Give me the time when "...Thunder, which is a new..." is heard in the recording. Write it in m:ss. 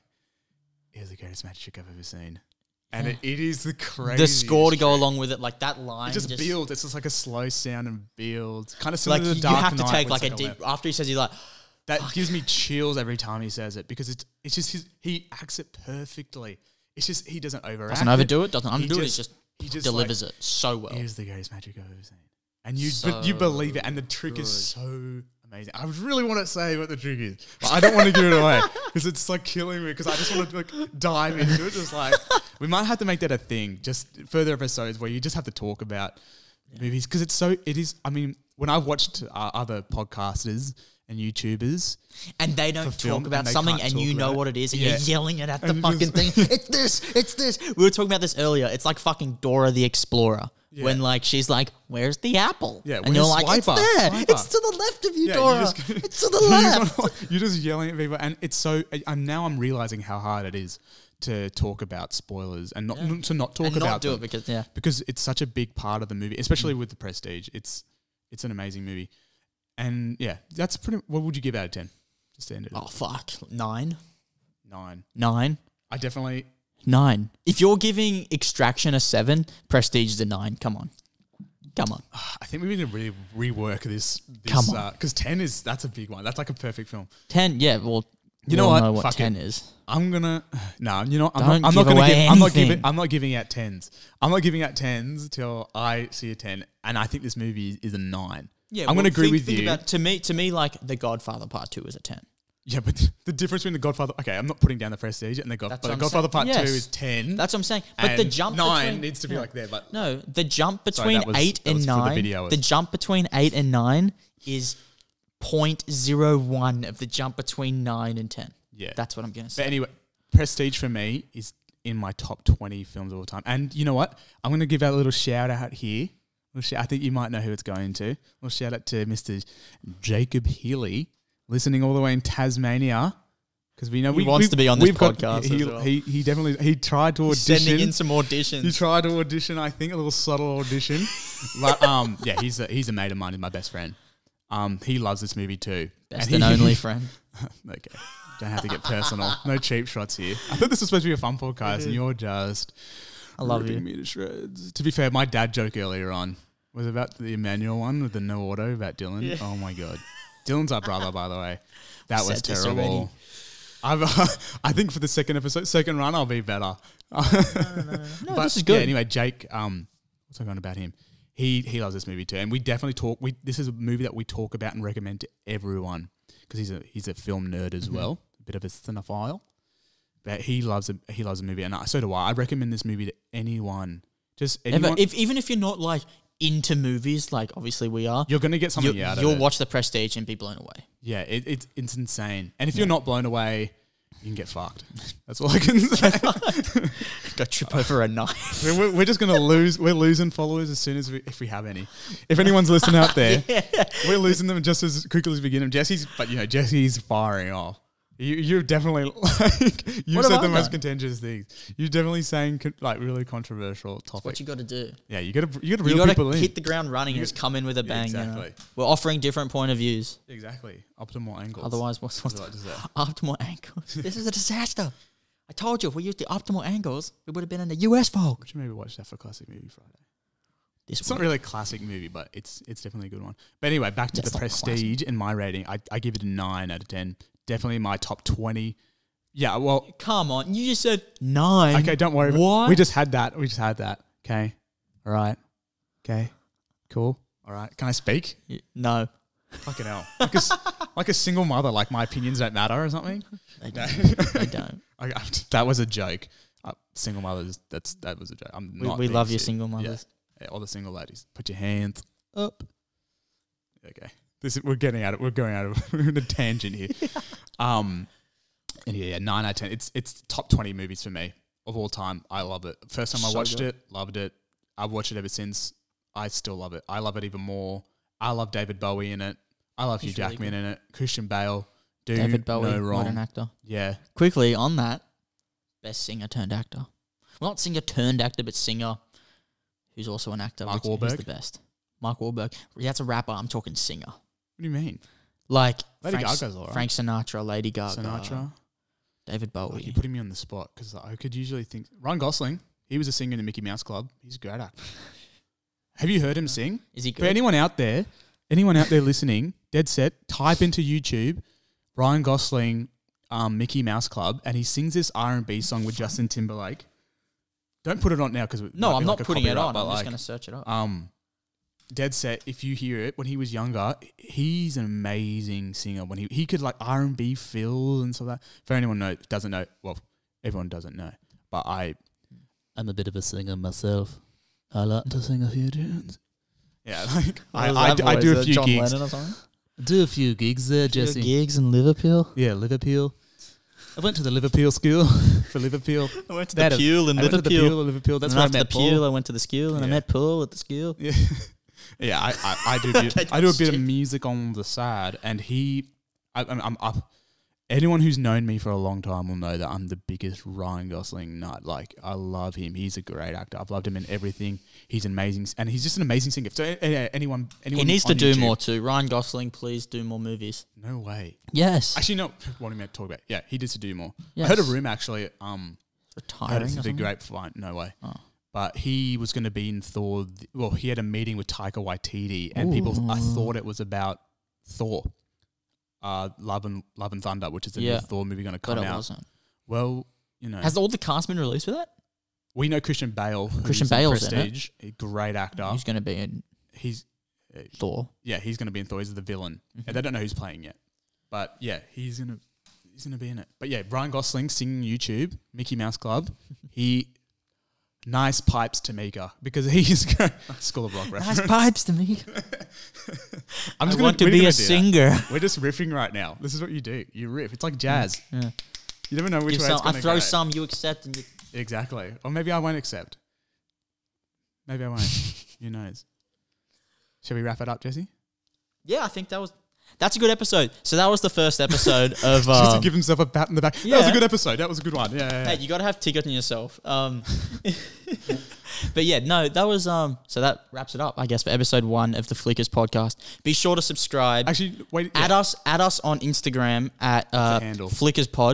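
6:27.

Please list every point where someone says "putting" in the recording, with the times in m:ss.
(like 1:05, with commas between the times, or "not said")
1:44, 4:59, 5:19.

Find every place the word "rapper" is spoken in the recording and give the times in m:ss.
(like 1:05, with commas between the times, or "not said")
4:53.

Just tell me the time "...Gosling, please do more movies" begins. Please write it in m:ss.
6:09.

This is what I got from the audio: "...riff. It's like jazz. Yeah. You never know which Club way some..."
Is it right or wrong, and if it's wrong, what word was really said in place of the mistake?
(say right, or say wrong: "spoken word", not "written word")
wrong: "Give", not "Club".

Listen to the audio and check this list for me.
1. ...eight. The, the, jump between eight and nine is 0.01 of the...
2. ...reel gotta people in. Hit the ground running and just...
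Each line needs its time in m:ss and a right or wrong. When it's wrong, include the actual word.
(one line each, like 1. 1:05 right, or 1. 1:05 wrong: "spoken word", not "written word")
1. 1:51 wrong: "nine", not "eight"
2. 3:35 right.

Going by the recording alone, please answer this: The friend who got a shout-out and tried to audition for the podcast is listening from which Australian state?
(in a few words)
Tasmania.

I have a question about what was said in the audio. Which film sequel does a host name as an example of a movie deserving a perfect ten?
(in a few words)
The Godfather Part Two.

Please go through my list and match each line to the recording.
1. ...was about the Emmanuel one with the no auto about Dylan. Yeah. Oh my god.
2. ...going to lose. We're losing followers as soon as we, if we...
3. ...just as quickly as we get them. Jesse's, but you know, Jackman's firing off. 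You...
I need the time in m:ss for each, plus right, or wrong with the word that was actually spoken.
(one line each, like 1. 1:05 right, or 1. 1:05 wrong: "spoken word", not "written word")
1. 2:36 right
2. 3:19 right
3. 3:24 wrong: "Jesse", not "Jackman".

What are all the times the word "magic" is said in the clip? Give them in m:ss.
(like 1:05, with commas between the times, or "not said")
0:01, 0:21.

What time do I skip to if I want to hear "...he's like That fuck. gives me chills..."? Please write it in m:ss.
0:11.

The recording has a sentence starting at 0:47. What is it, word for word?
We were talking about this earlier.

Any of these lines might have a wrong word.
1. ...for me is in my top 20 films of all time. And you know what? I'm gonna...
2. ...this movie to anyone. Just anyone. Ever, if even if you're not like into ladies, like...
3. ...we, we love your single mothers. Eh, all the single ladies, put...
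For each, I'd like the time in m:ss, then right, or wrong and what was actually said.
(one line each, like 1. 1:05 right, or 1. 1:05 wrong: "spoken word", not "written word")
1. 2:00 right
2. 3:02 wrong: "movies", not "ladies"
3. 4:18 right.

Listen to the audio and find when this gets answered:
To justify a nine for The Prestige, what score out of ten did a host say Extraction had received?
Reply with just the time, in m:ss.
1:18.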